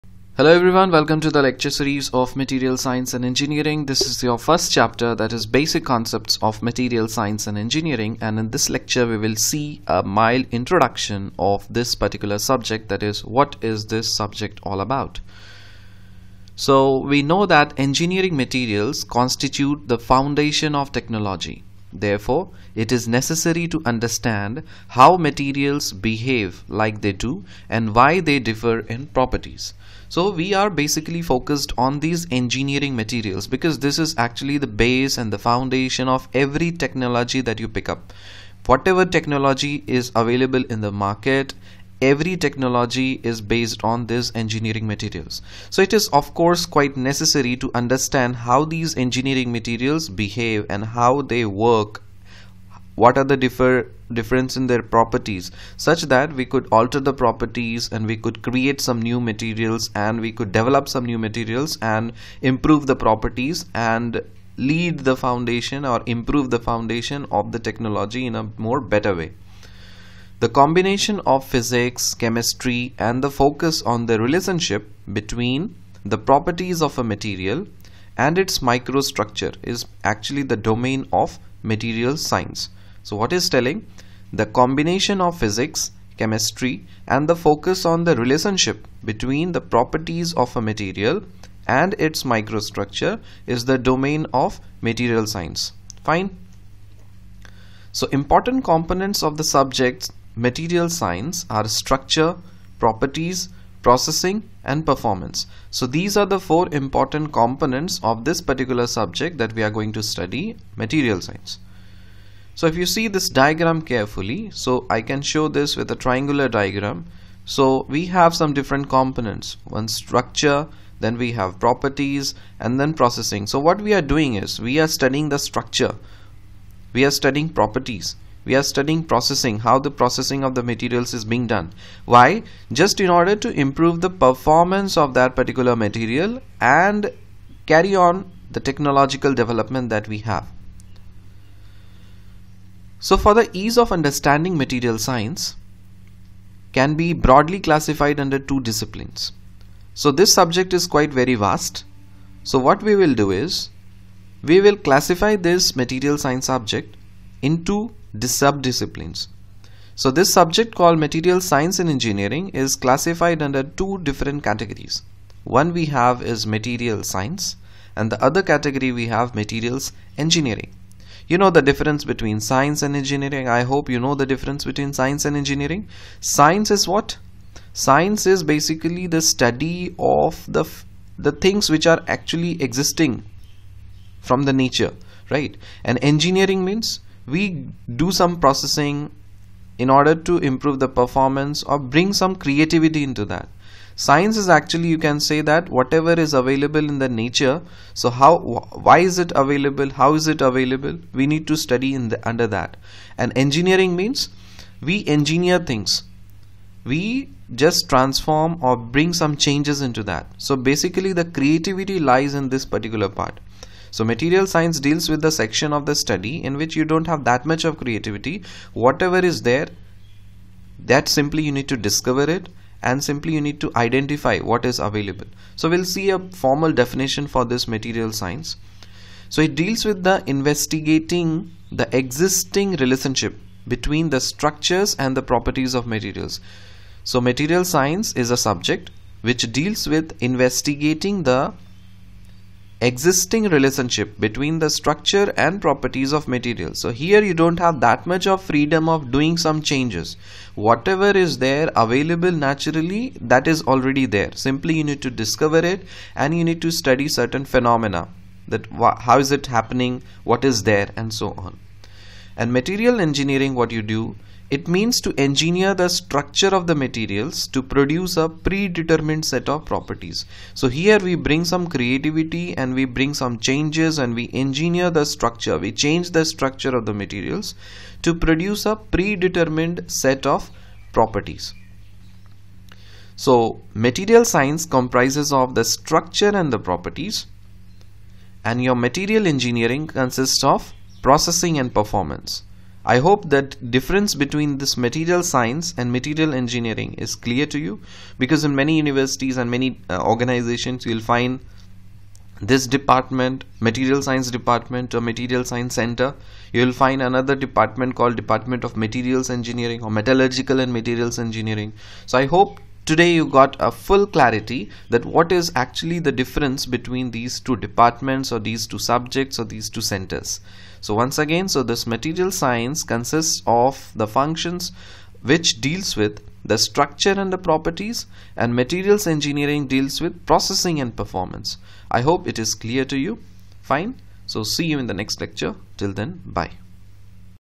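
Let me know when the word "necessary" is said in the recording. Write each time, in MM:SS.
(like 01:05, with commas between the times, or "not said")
00:23, 00:46.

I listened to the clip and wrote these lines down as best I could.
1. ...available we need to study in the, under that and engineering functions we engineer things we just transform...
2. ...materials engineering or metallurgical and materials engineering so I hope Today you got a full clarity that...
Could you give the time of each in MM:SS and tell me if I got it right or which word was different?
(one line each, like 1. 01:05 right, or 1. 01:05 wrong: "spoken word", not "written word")
1. 03:20 wrong: "means", not "functions"
2. 05:08 right.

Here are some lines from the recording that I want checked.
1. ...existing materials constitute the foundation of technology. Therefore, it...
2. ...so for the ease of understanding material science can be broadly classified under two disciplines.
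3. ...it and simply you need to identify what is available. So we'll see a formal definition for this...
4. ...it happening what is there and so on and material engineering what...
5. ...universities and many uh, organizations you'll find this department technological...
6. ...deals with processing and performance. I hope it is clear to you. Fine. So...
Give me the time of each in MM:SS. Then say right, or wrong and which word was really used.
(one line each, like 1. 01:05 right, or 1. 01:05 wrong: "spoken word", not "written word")
1. 00:17 wrong: "engineering", not "existing"
2. 02:23 right
3. 03:42 right
4. 04:19 right
5. 04:58 wrong: "material", not "technological"
6. 05:29 right.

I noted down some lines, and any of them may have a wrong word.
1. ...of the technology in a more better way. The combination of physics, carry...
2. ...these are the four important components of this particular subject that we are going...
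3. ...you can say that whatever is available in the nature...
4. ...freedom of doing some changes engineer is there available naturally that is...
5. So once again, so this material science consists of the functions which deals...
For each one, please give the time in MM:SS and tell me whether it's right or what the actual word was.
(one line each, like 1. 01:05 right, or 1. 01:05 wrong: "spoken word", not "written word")
1. 01:07 wrong: "chemistry", not "carry"
2. 01:45 right
3. 03:14 right
4. 04:08 wrong: "whatever", not "engineer"
5. 05:20 right.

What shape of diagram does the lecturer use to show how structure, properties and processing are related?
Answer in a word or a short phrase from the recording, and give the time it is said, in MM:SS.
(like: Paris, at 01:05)
Triangular, at 01:55.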